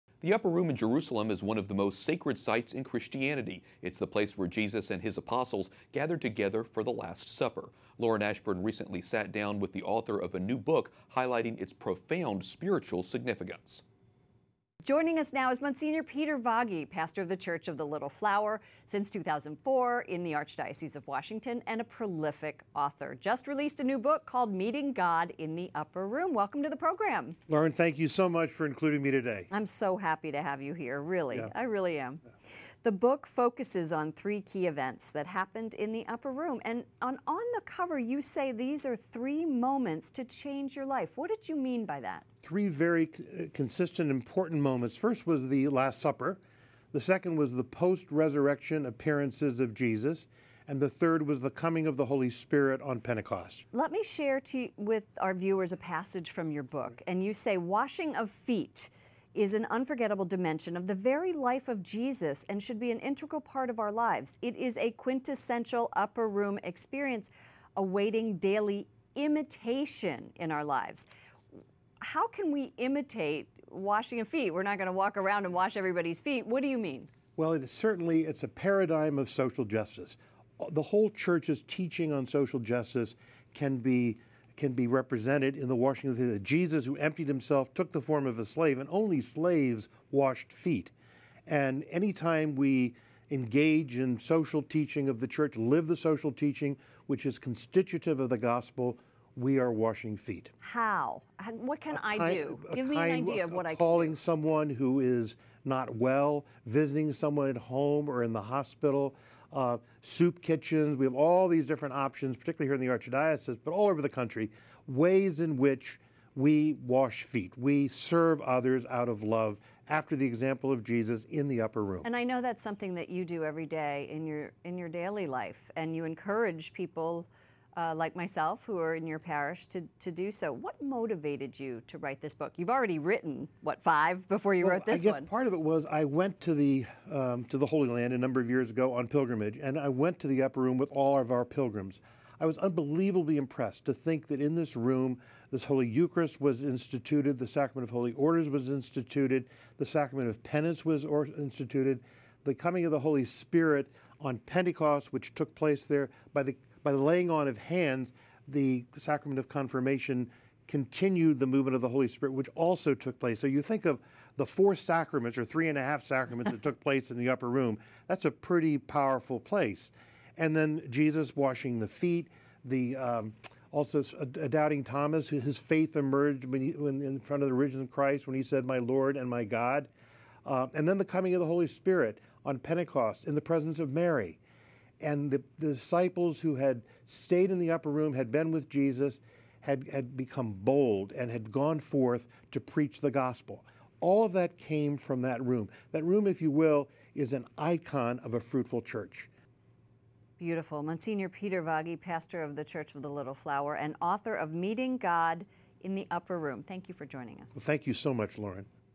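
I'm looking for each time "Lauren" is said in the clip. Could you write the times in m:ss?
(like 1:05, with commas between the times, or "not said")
0:07, 0:27, 3:28.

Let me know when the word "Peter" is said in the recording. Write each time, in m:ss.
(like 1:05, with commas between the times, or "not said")
0:16, 3:21.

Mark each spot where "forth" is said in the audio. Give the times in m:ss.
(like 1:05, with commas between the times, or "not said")
3:11.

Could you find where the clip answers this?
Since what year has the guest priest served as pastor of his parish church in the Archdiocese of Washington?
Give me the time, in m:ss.
0:19.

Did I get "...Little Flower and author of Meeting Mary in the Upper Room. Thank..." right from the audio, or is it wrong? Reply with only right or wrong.
wrong.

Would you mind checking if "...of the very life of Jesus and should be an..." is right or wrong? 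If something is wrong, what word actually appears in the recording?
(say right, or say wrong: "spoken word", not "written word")
right.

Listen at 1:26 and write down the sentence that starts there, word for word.
Jesus, who emptied himself, took the form of a slave, and only slaves washed feet.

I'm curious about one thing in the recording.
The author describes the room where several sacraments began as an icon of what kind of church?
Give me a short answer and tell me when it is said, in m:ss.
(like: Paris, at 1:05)
a fruitful church, at 3:18.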